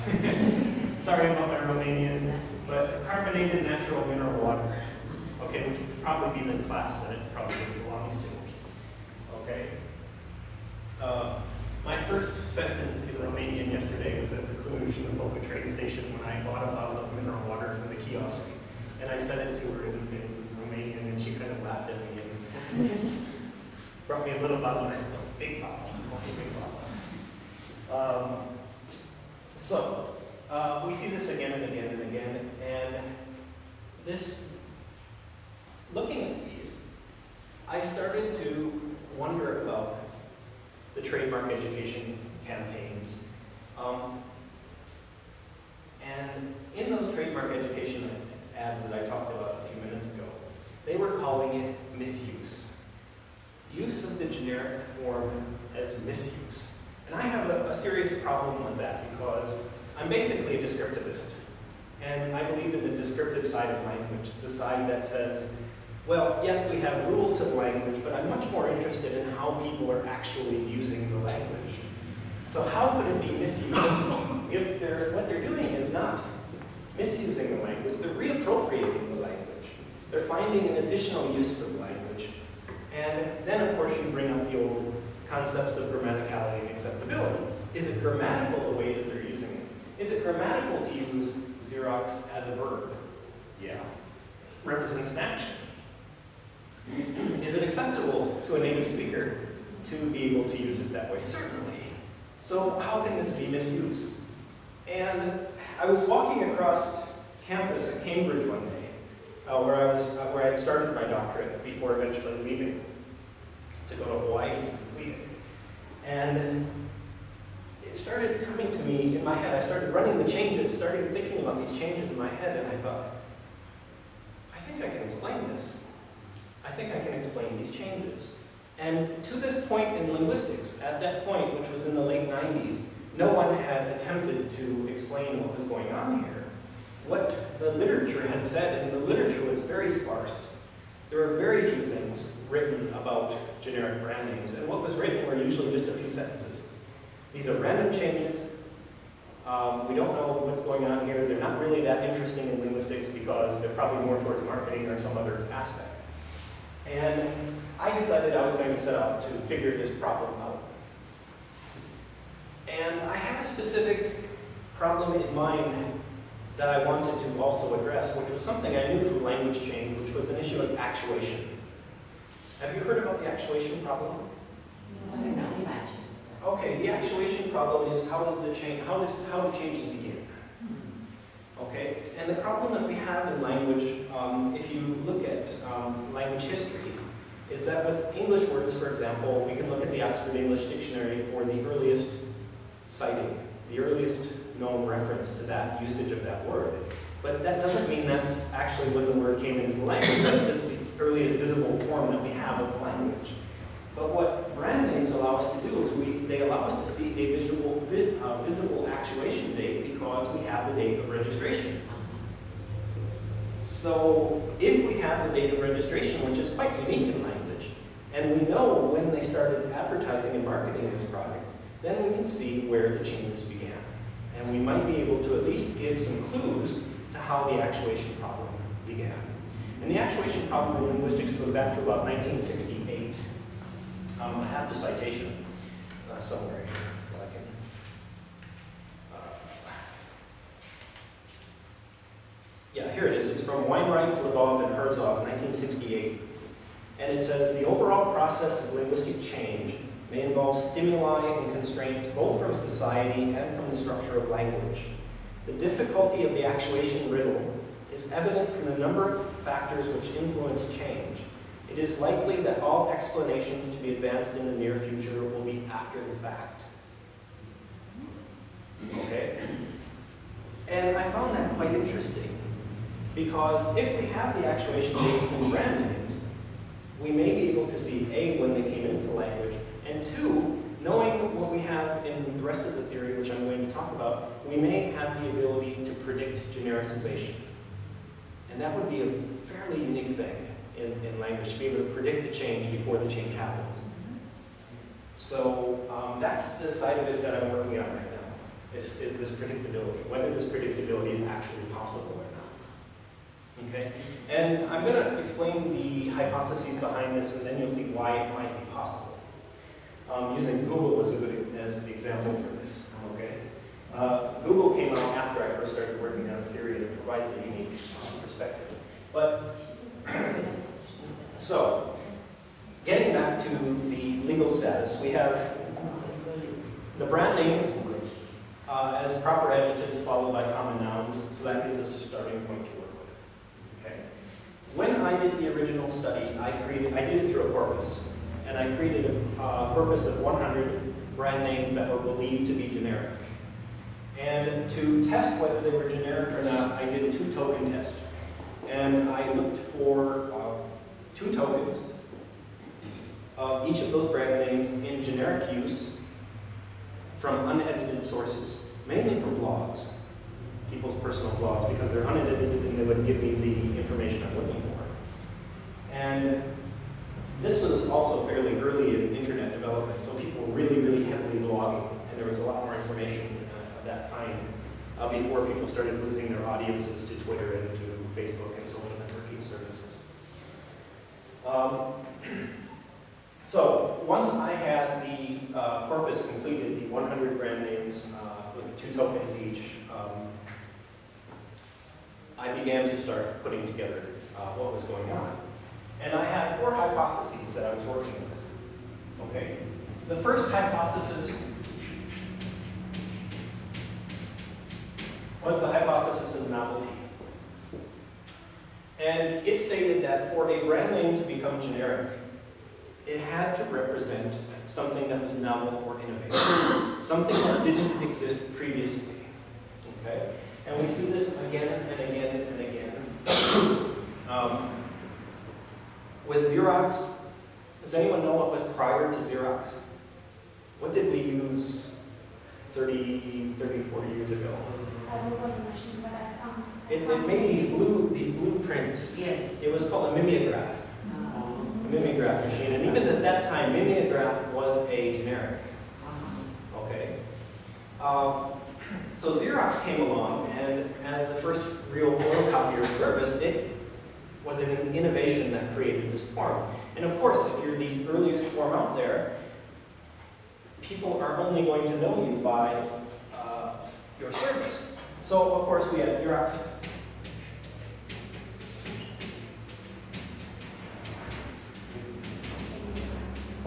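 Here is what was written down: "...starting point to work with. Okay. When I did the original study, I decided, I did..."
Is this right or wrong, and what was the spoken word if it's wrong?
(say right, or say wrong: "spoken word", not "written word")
wrong: "created", not "decided".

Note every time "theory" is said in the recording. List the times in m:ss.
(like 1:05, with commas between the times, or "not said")
4:42, 5:16.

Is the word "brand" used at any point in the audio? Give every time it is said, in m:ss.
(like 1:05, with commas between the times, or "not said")
2:24, 3:24, 4:35, 5:27, 5:41, 5:54, 6:27, 6:50.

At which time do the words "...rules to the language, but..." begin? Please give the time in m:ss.
1:07.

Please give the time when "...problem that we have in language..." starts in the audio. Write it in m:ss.
3:02.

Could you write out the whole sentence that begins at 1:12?
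So how could it be misused if they're, what they're doing is not misusing the language, they're reappropriating the language.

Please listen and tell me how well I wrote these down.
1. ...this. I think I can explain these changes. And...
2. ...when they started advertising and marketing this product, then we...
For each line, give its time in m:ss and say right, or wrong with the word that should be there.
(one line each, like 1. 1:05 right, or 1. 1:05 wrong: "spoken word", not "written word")
1. 2:05 right
2. 3:38 right.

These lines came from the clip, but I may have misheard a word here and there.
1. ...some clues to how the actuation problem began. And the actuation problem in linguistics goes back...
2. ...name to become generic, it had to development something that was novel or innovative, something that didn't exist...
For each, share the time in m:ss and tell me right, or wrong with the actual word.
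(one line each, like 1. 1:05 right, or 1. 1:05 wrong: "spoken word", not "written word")
1. 3:46 right
2. 6:50 wrong: "represent", not "development".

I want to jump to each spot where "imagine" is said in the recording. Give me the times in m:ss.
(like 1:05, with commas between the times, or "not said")
2:55.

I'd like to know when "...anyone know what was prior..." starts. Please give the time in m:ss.
7:07.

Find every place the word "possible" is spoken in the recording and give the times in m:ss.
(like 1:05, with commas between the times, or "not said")
5:01, 5:08.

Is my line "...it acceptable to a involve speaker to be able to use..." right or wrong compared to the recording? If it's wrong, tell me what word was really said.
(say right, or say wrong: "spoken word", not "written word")
wrong: "native", not "involve".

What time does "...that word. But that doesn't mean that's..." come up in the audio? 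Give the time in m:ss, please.
3:16.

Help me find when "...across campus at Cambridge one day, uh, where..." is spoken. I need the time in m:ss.
1:46.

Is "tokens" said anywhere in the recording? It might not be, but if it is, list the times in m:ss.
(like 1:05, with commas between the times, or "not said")
5:47, 5:51, 6:28.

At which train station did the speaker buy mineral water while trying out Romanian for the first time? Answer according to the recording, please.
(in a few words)
Cluj the Boca.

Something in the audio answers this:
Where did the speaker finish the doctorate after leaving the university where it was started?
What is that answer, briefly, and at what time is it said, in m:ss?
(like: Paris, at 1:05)
Hawaii, at 1:54.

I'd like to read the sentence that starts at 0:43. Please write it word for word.
Um, and in those trademark education ads that I talked about a few minutes ago, they were calling it misuse.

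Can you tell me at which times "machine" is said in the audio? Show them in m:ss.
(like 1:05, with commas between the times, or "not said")
7:15, 7:22.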